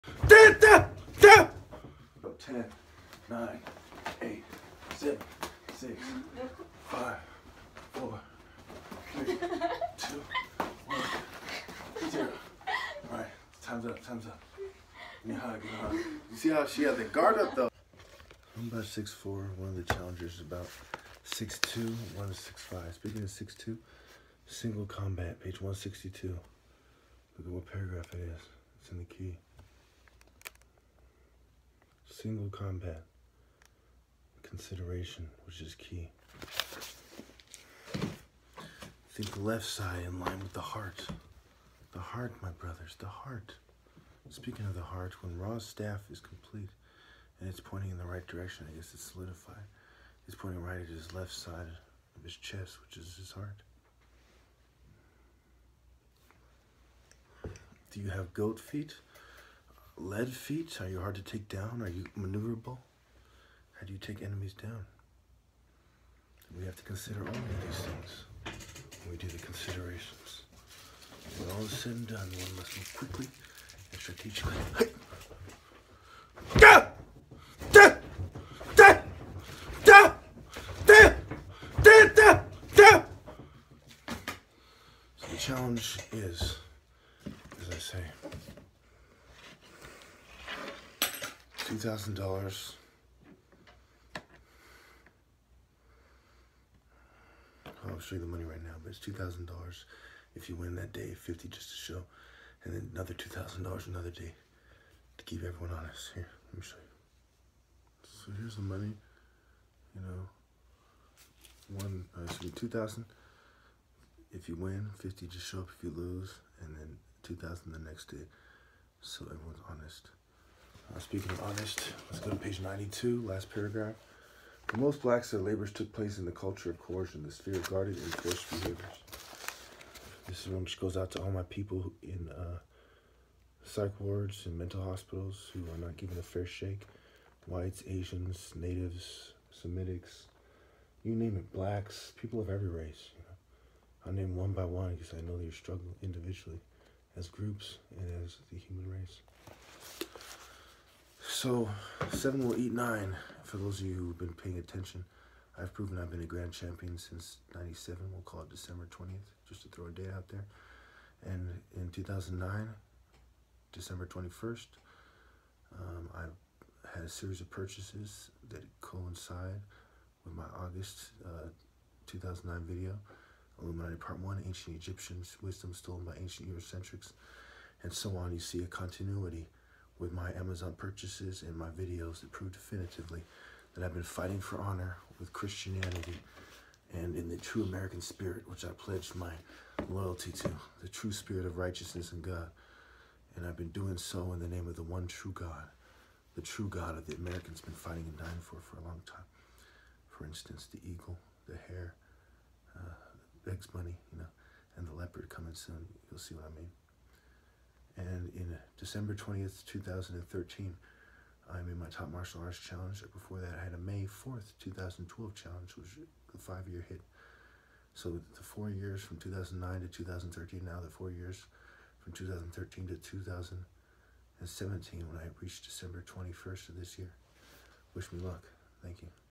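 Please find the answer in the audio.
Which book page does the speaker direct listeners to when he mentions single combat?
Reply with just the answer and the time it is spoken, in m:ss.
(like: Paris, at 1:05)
162, at 0:25.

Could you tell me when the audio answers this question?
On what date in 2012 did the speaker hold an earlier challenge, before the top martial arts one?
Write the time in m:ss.
3:33.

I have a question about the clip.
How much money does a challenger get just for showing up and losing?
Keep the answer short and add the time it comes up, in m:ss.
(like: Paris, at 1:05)
50, at 1:41.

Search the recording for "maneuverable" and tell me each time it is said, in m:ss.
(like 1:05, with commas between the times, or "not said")
1:02.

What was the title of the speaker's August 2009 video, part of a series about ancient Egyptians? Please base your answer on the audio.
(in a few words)
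Illuminati Part 1.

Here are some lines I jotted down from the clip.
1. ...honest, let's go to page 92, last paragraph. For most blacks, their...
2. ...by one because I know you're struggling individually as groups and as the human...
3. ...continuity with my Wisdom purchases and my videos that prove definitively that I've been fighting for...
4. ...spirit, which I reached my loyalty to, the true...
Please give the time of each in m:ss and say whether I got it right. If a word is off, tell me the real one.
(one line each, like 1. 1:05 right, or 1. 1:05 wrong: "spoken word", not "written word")
1. 2:01 right
2. 2:24 right
3. 2:58 wrong: "Amazon", not "Wisdom"
4. 3:08 wrong: "pledged", not "reached".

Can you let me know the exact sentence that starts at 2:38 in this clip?
We'll call it December 20th, just to throw a date out there.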